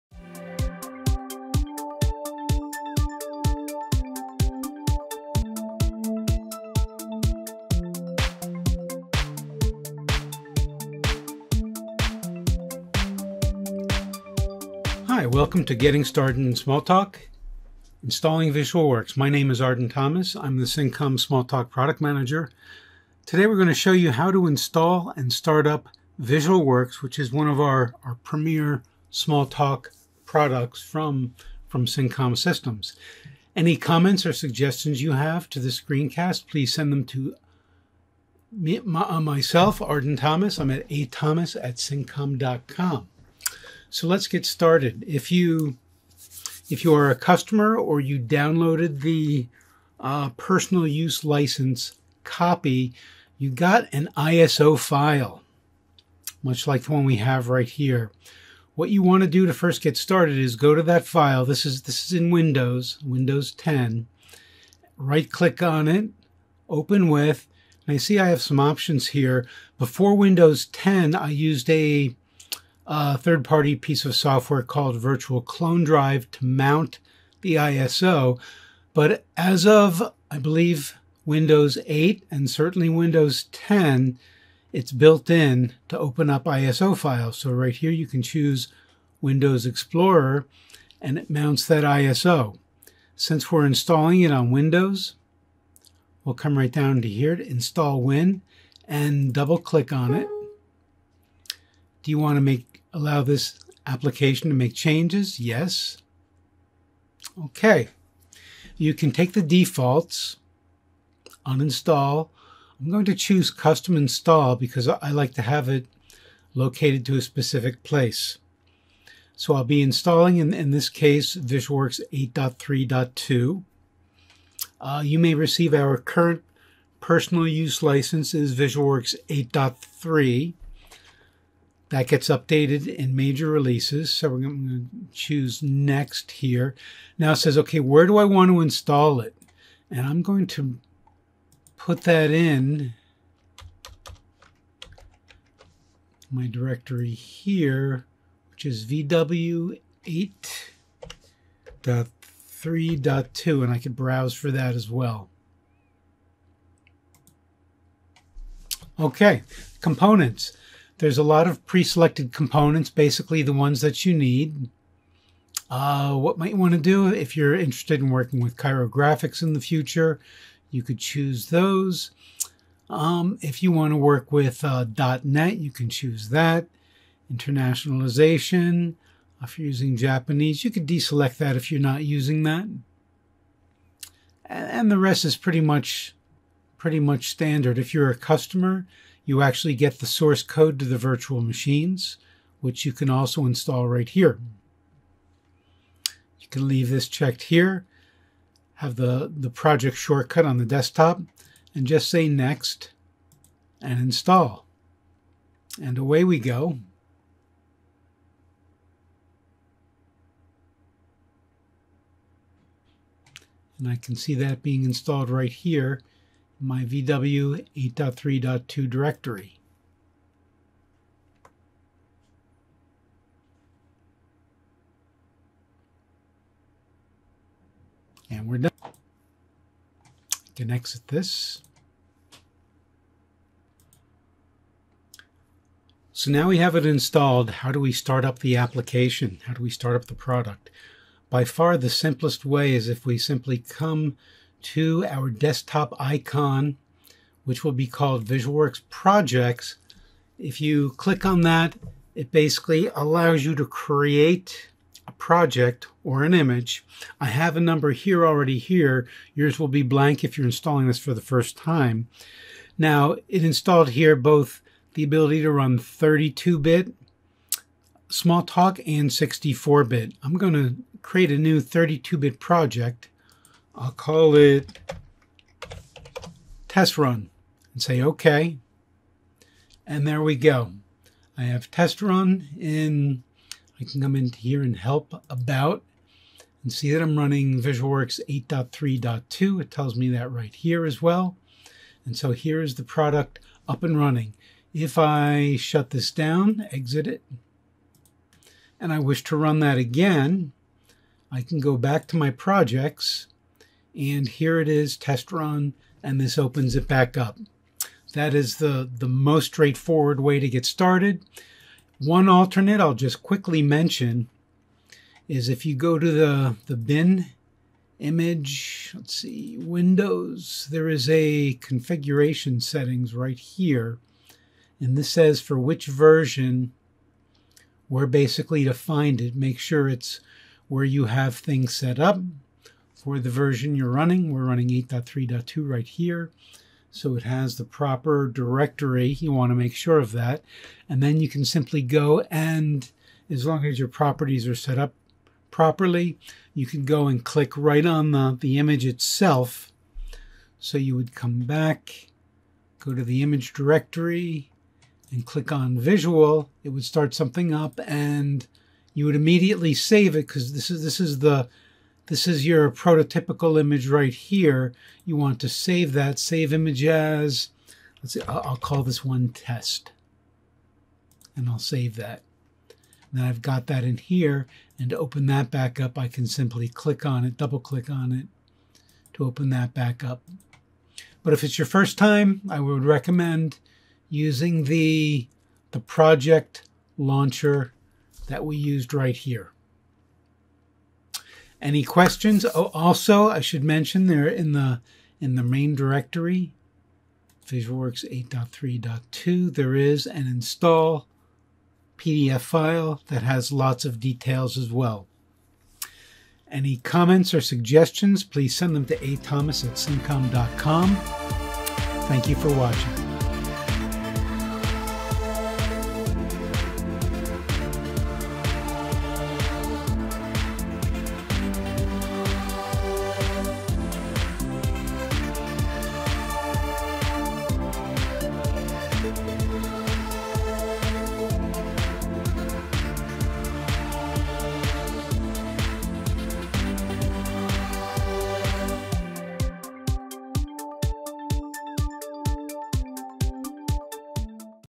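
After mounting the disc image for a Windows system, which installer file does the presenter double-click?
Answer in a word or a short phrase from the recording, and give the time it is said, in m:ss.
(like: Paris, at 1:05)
install Win, at 1:37.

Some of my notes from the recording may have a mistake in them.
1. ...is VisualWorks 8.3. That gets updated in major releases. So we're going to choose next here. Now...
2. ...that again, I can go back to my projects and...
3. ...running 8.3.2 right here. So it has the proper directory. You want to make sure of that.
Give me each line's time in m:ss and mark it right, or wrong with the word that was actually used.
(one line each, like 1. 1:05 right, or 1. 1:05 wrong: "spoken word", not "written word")
1. 2:08 right
2. 4:59 right
3. 5:34 right.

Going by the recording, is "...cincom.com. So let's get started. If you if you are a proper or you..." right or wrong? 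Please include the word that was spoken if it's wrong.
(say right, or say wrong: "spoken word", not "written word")
wrong: "customer", not "proper".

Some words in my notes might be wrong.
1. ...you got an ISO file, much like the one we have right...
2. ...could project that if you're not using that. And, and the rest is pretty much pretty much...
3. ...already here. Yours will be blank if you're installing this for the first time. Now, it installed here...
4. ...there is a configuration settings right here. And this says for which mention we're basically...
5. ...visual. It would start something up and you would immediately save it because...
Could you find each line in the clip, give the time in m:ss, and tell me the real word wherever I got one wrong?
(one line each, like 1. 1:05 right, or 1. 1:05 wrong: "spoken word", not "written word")
1. 0:53 right
2. 3:00 wrong: "deselect", not "project"
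3. 4:18 right
4. 5:20 wrong: "version", not "mention"
5. 5:55 right.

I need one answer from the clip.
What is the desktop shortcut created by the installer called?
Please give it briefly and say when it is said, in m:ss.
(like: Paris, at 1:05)
VisualWorks Projects, at 4:08.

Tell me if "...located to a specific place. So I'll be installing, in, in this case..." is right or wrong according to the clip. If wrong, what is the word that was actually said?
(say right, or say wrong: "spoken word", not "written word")
right.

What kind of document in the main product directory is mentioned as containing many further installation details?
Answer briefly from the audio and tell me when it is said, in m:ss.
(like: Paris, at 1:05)
install PDF, at 6:40.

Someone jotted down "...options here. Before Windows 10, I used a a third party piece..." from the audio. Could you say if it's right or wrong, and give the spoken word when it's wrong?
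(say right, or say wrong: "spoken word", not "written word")
right.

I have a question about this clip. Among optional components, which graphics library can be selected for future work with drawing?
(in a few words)
Cairo.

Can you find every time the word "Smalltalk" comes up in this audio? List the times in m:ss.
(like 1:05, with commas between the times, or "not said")
0:16, 0:21, 0:29, 4:28.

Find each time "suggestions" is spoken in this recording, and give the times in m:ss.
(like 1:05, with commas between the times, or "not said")
0:34, 6:47.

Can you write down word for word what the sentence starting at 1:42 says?
Do you want to make Allow this application to make changes, yes.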